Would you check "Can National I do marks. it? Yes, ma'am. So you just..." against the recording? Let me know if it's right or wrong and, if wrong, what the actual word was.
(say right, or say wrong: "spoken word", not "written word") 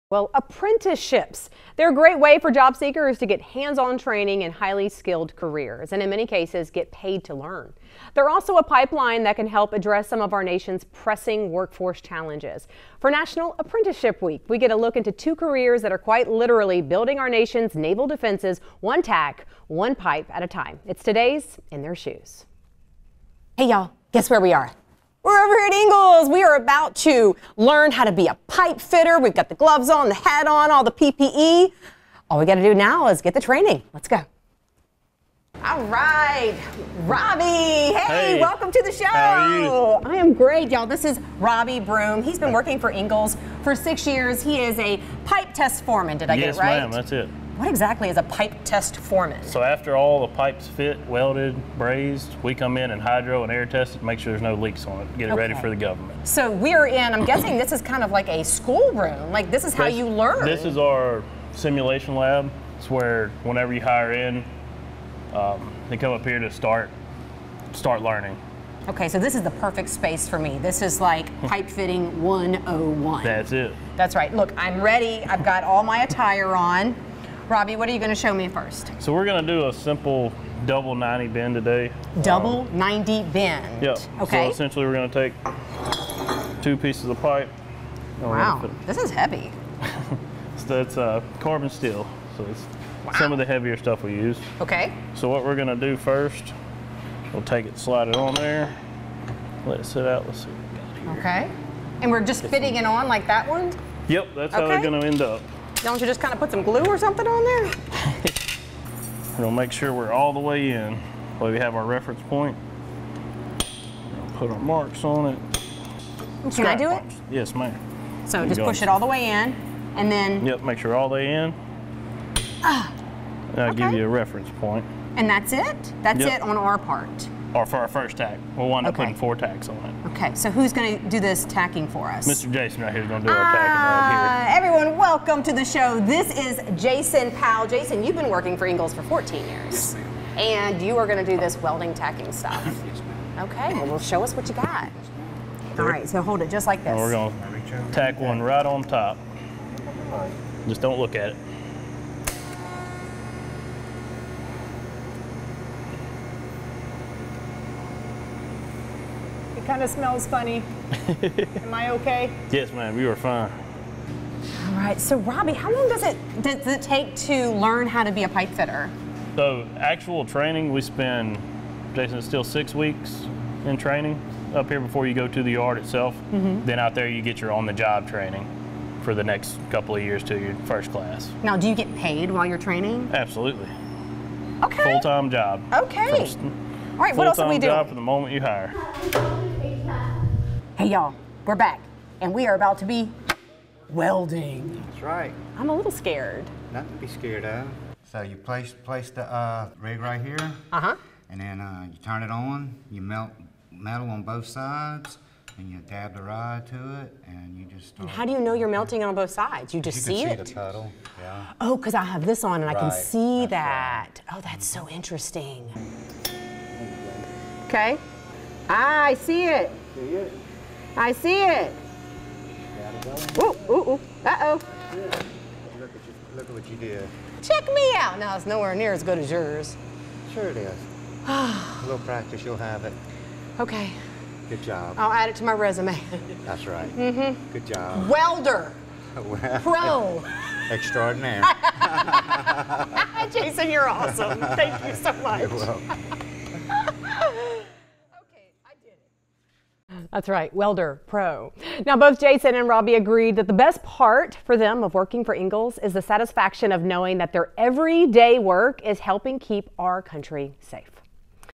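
wrong: "Scrap", not "National".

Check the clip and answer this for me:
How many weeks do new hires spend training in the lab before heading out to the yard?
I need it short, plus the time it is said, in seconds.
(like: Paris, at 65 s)
6, at 172 s.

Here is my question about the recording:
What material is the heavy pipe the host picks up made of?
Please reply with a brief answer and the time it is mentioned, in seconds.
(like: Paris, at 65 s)
Carbon steel, at 91 s.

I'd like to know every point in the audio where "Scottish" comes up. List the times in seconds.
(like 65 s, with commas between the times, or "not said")
not said.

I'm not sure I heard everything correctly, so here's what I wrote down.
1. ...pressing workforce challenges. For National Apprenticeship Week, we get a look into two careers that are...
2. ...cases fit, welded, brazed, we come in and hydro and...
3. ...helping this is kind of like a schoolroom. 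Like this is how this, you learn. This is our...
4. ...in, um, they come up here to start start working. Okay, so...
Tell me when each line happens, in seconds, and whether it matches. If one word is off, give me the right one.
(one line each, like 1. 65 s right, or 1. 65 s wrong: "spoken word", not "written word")
1. 10 s right
2. 50 s wrong: "pipes", not "cases"
3. 57 s wrong: "guessing", not "helping"
4. 64 s wrong: "learning", not "working".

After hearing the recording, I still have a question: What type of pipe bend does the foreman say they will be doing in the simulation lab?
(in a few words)
Double 90 bend.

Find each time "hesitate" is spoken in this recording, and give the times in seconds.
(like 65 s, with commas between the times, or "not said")
not said.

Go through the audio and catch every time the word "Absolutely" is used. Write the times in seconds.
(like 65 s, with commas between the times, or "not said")
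183 s.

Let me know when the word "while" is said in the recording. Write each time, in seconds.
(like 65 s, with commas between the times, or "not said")
182 s.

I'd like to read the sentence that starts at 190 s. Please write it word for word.
Hey, y'all, we're back, and we are about to be welding.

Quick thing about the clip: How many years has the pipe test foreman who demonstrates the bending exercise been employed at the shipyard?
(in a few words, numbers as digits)
6.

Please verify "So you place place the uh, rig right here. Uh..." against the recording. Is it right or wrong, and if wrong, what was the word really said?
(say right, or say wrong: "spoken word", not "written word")
right.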